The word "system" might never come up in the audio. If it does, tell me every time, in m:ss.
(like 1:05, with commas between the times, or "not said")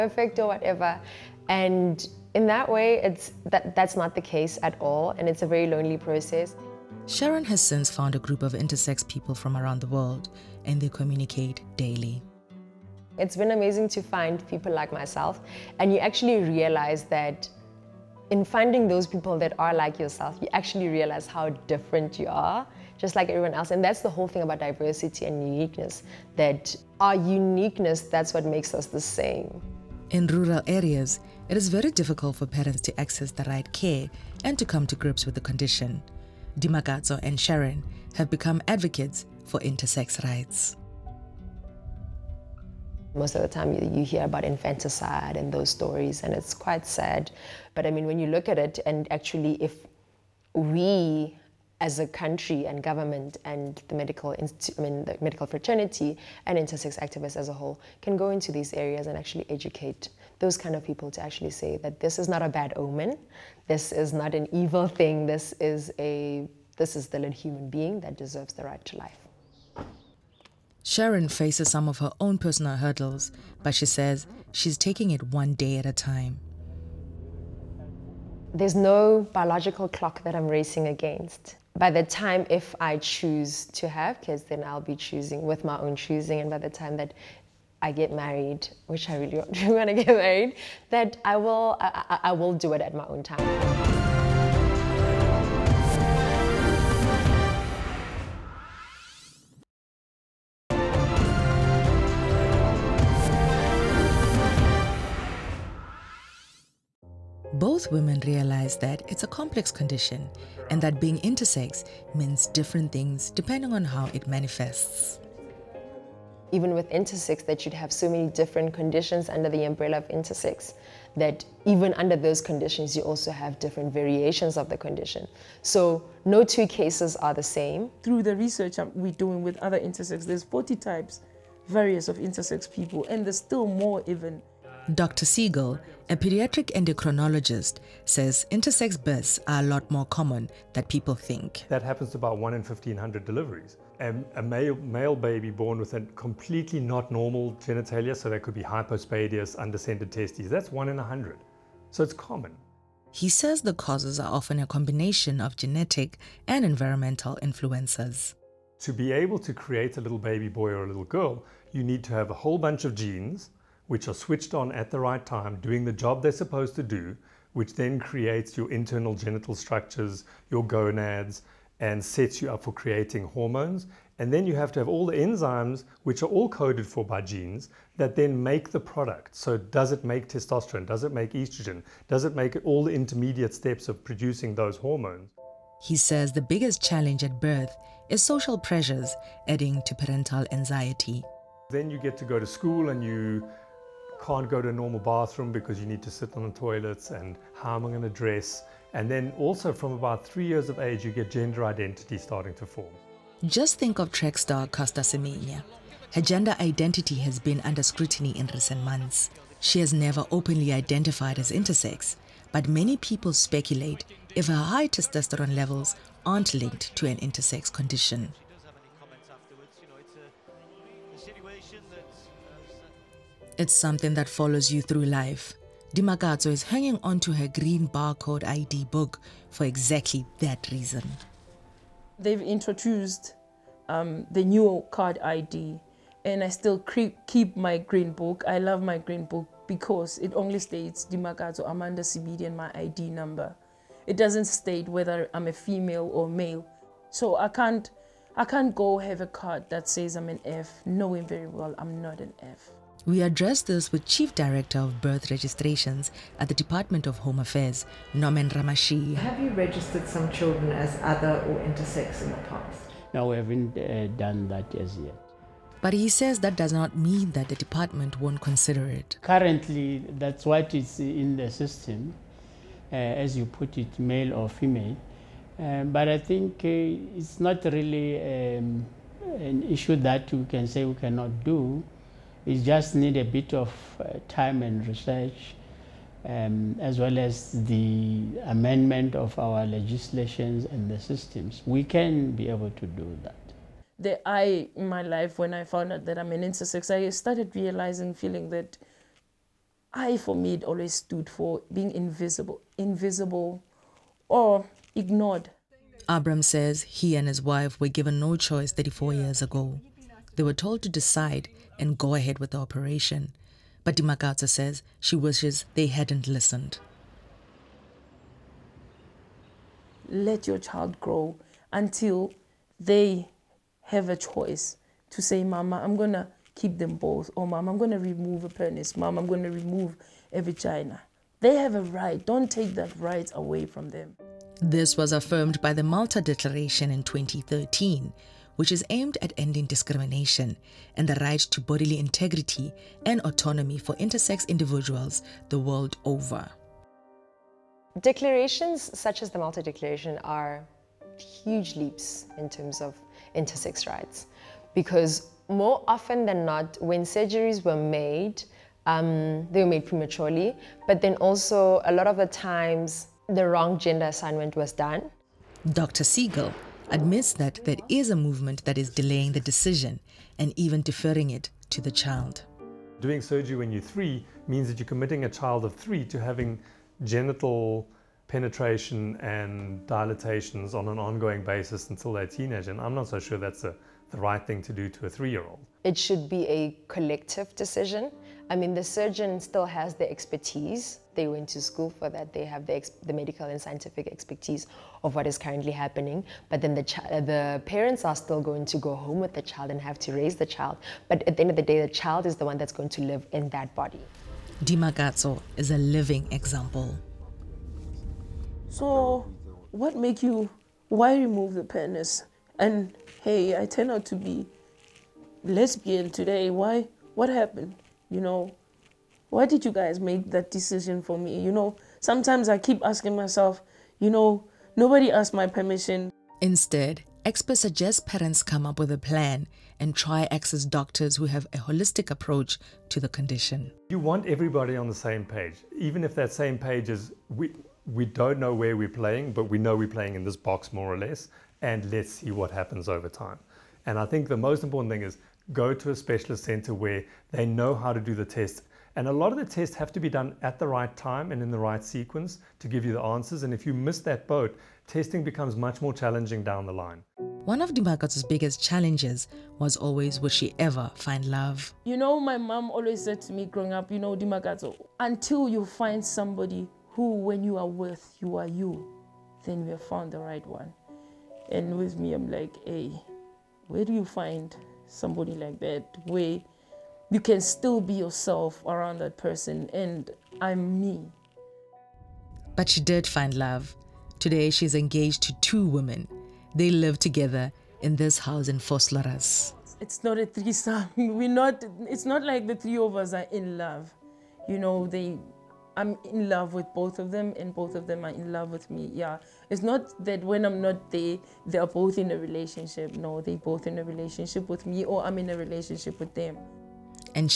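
4:31, 4:50.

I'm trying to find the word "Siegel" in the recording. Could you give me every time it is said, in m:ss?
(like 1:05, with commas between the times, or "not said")
2:15, 6:06.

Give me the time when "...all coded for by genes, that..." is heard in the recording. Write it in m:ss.
2:56.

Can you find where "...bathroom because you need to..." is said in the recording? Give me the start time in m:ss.
3:14.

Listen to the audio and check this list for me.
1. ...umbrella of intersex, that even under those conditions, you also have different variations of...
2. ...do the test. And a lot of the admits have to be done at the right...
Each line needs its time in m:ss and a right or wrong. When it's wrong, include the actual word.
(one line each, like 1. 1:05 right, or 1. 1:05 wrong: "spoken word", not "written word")
1. 1:59 right
2. 7:27 wrong: "tests", not "admits".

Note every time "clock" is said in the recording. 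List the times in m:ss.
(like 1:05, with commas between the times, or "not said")
1:19.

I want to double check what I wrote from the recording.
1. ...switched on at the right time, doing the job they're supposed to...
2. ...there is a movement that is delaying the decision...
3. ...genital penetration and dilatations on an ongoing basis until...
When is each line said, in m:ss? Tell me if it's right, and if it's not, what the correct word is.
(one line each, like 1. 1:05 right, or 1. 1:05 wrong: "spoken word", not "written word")
1. 2:44 right
2. 6:07 right
3. 6:17 right.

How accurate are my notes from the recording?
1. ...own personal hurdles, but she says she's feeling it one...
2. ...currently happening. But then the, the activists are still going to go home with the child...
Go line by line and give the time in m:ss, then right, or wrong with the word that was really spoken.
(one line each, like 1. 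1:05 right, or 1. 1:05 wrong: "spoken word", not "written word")
1. 1:12 wrong: "taking", not "feeling"
2. 6:35 wrong: "parents", not "activists".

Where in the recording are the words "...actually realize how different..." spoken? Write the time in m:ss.
0:20.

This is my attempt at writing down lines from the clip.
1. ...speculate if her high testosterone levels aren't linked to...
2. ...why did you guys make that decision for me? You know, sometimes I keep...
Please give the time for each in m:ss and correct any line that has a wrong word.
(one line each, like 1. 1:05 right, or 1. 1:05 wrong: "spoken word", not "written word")
1. 3:33 right
2. 6:59 right.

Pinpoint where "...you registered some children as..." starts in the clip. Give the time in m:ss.
4:19.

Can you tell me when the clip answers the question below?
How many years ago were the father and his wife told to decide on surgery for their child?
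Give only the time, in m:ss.
5:08.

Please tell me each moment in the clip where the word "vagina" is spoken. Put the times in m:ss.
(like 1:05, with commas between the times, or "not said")
5:30.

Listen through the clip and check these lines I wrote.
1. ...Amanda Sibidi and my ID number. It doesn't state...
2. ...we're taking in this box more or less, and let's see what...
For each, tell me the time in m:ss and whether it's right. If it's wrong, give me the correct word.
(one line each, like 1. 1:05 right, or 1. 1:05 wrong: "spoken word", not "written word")
1. 4:01 right
2. 7:19 wrong: "playing", not "taking".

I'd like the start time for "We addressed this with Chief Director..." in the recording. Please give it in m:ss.
4:13.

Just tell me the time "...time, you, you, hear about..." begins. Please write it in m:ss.
0:43.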